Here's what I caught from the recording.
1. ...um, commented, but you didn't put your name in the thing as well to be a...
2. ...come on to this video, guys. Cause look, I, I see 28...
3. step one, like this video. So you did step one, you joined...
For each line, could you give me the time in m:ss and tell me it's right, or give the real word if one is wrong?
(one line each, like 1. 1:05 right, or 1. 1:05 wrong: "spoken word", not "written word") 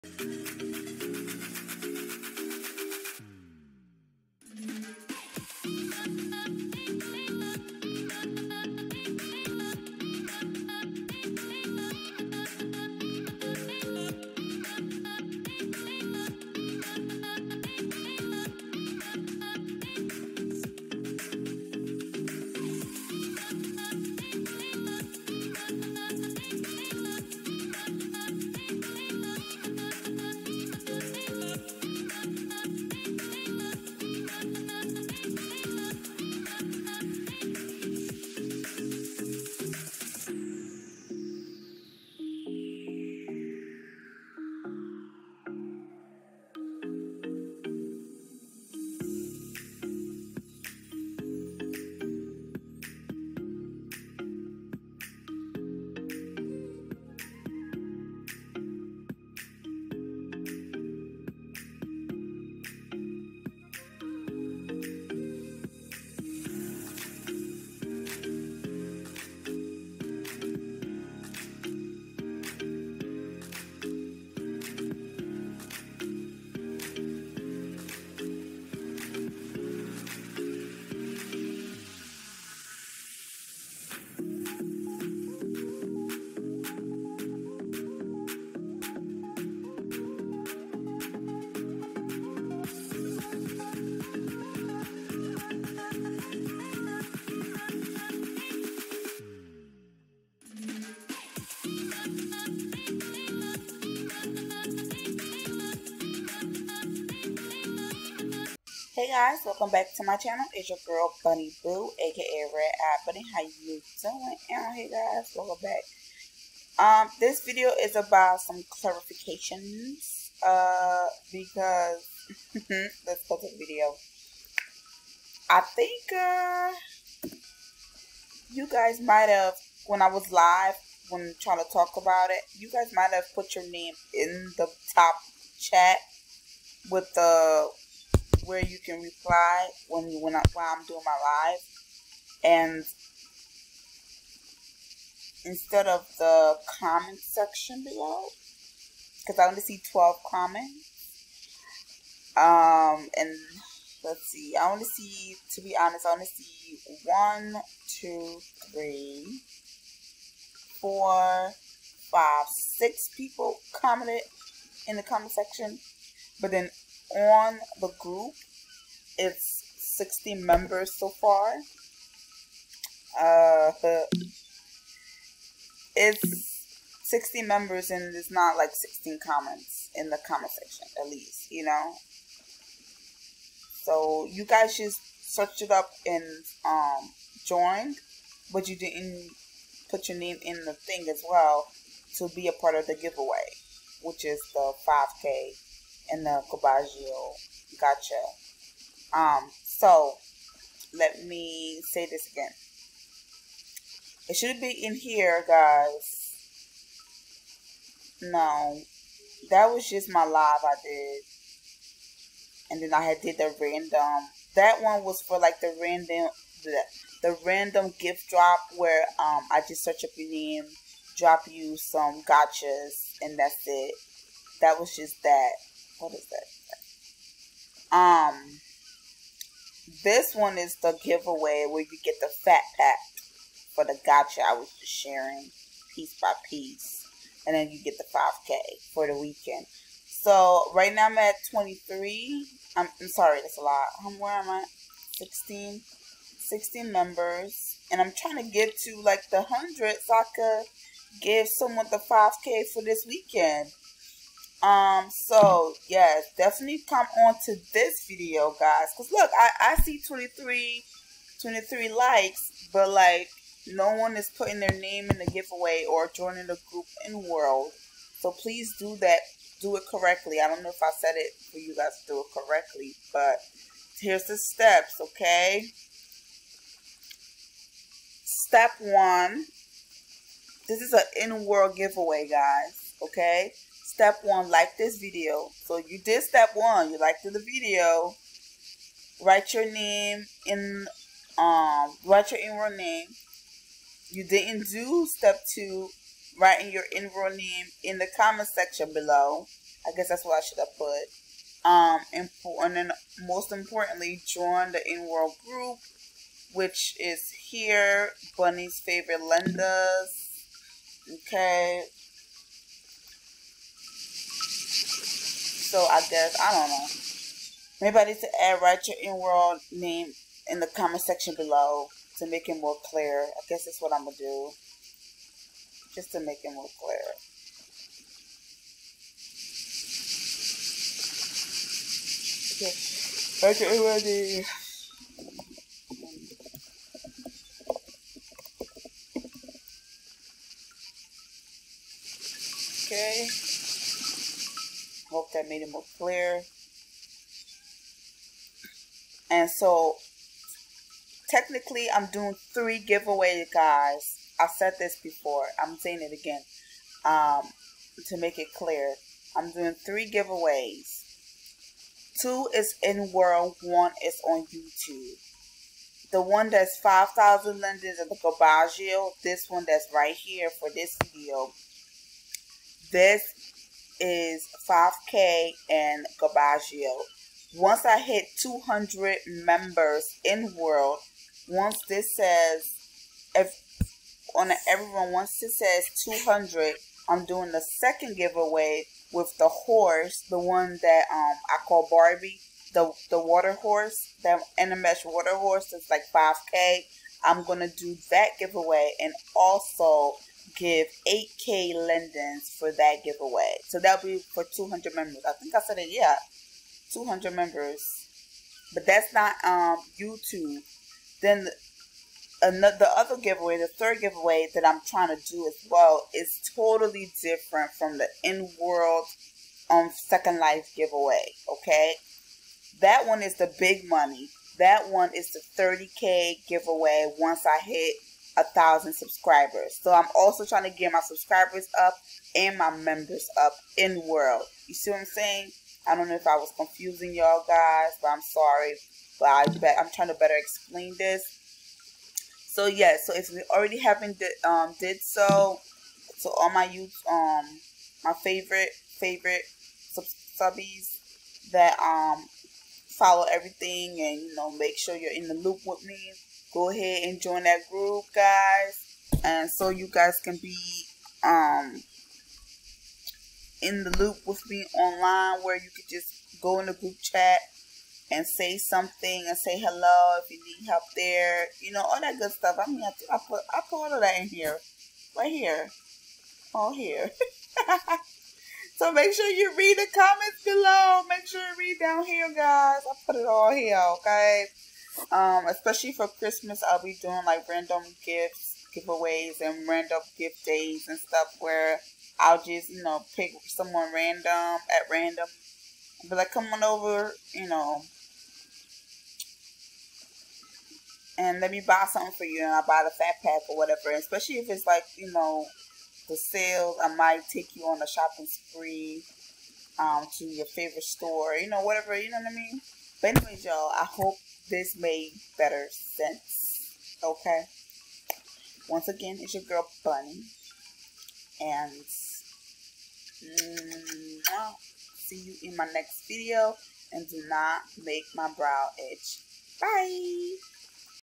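1. 3:06 wrong: "joined", not "commented"
2. 4:16 wrong: "23", not "28"
3. 4:43 wrong: "liked", not "joined".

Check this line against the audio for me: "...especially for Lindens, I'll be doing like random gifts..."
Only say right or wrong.
wrong.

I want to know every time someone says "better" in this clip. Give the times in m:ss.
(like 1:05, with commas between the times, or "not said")
7:20, 8:35.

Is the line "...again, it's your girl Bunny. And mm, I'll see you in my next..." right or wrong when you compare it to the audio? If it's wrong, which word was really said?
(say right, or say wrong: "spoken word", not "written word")
right.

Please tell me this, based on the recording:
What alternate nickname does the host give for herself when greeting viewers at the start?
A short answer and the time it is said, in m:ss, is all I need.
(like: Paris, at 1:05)
Red Eye Bunny, at 1:52.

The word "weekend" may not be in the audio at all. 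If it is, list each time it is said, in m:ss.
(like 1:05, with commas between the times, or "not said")
3:59, 4:13.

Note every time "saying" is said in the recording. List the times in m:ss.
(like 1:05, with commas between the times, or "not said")
5:55, 7:15.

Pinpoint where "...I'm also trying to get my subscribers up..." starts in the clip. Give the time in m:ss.
7:09.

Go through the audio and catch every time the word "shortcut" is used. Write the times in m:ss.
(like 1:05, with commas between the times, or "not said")
not said.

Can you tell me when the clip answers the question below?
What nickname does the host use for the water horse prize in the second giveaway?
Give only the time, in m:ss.
6:31.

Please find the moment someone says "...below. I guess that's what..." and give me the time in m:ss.
4:58.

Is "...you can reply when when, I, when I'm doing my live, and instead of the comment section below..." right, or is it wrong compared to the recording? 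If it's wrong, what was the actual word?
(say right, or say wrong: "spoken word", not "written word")
right.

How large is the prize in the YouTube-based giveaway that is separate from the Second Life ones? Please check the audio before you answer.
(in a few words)
30k.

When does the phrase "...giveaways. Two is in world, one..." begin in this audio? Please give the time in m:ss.
6:00.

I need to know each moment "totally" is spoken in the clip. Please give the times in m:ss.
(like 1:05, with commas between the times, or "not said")
6:56.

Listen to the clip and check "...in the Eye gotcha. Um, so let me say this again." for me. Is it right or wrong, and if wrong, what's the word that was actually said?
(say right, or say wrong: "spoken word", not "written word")
wrong: "Cobaggio", not "Eye".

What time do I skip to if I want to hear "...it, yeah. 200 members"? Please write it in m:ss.
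6:45.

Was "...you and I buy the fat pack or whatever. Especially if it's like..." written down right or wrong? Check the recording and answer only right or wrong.
right.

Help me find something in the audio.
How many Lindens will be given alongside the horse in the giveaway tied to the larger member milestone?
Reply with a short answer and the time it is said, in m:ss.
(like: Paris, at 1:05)
8K, at 6:41.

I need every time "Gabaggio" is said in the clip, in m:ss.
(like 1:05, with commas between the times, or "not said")
6:08, 6:16.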